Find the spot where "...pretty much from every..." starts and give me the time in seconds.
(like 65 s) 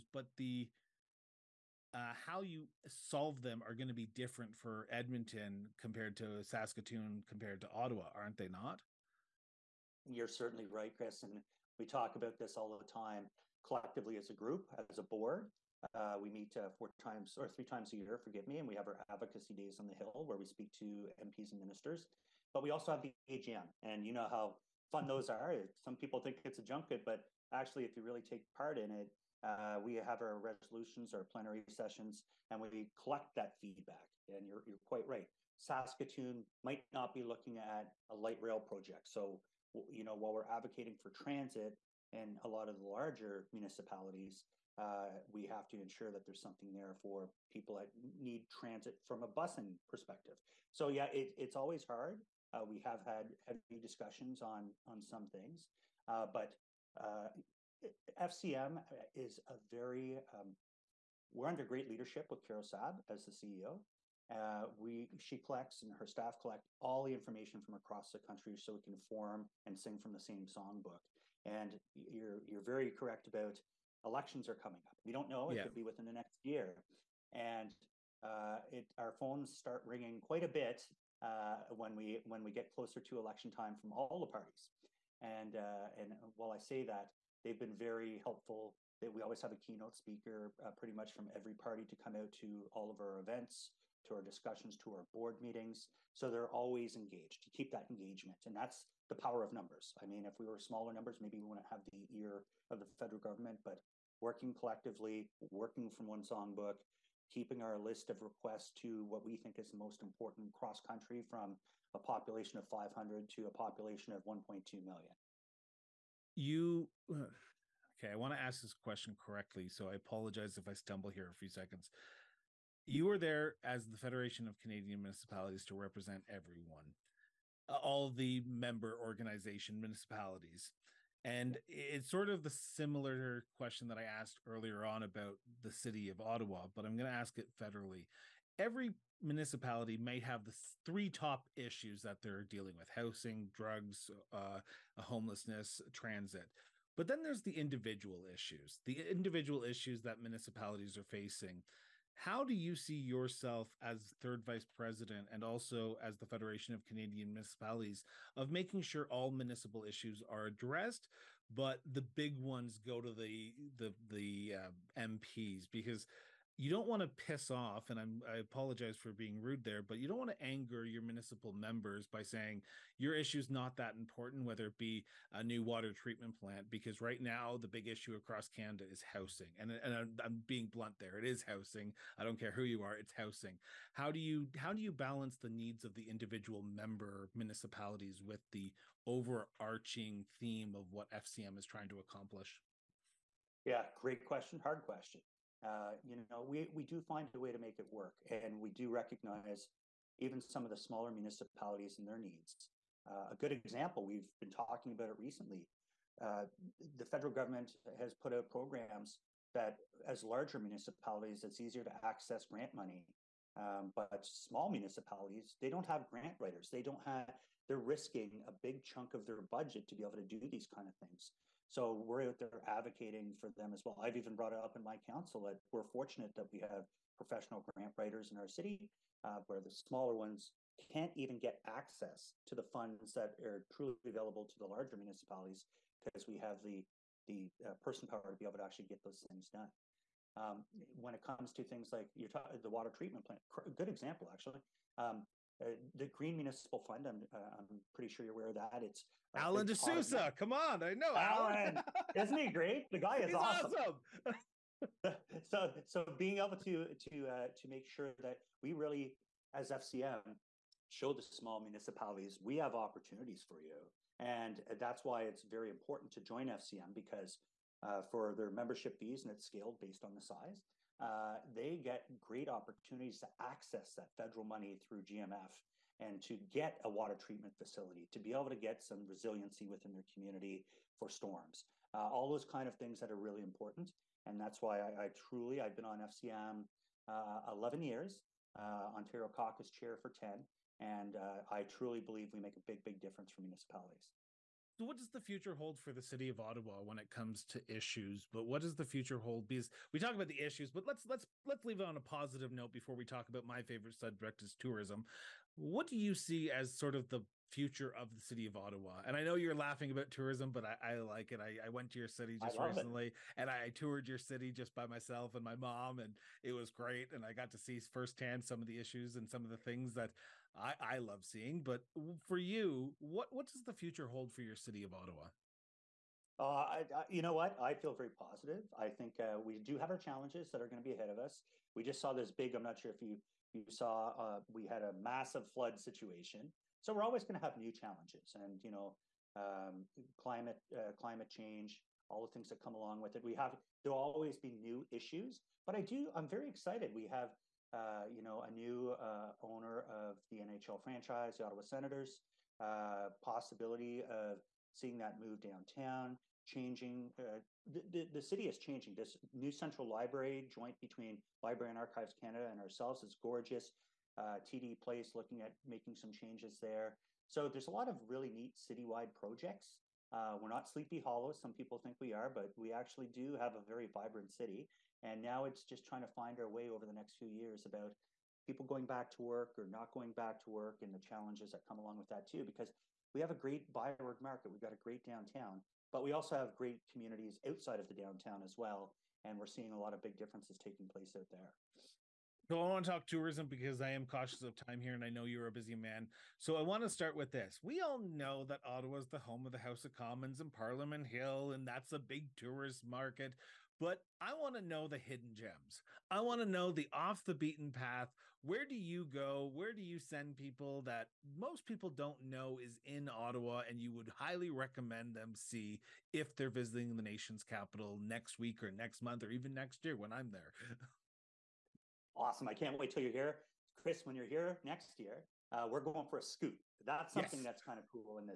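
90 s.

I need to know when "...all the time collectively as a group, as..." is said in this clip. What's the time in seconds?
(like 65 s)
12 s.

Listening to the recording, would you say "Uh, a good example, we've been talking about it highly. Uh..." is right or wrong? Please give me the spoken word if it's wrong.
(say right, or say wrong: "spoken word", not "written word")
wrong: "recently", not "highly".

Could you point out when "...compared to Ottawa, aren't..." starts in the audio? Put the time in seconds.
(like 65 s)
7 s.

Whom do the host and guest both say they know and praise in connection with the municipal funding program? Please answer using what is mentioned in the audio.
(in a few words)
Alan DeSouza.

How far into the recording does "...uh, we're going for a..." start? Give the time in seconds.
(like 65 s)
425 s.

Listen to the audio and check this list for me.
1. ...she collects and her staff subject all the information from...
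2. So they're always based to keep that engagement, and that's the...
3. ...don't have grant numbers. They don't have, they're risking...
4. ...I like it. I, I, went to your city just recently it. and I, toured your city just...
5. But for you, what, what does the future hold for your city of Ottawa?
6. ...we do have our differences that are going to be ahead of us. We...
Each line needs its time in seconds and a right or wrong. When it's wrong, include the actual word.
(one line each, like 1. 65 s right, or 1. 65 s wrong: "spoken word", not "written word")
1. 65 s wrong: "collect", not "subject"
2. 96 s wrong: "engaged", not "based"
3. 215 s wrong: "writers", not "numbers"
4. 310 s right
5. 321 s right
6. 329 s wrong: "challenges", not "differences".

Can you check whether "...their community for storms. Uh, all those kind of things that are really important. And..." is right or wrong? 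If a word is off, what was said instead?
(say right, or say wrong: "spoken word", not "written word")
right.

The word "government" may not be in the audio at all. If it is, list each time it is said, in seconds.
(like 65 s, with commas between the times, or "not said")
103 s, 207 s.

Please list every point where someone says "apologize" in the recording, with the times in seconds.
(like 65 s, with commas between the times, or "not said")
119 s, 168 s.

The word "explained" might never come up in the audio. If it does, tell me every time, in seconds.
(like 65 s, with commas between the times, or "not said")
not said.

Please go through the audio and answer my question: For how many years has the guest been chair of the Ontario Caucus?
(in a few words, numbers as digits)
10.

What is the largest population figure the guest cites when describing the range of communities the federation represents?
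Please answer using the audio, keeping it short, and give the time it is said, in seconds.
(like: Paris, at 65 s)
1.2 million, at 114 s.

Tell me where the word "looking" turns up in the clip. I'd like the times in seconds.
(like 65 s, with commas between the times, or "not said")
37 s, 365 s.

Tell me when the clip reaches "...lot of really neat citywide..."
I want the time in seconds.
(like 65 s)
367 s.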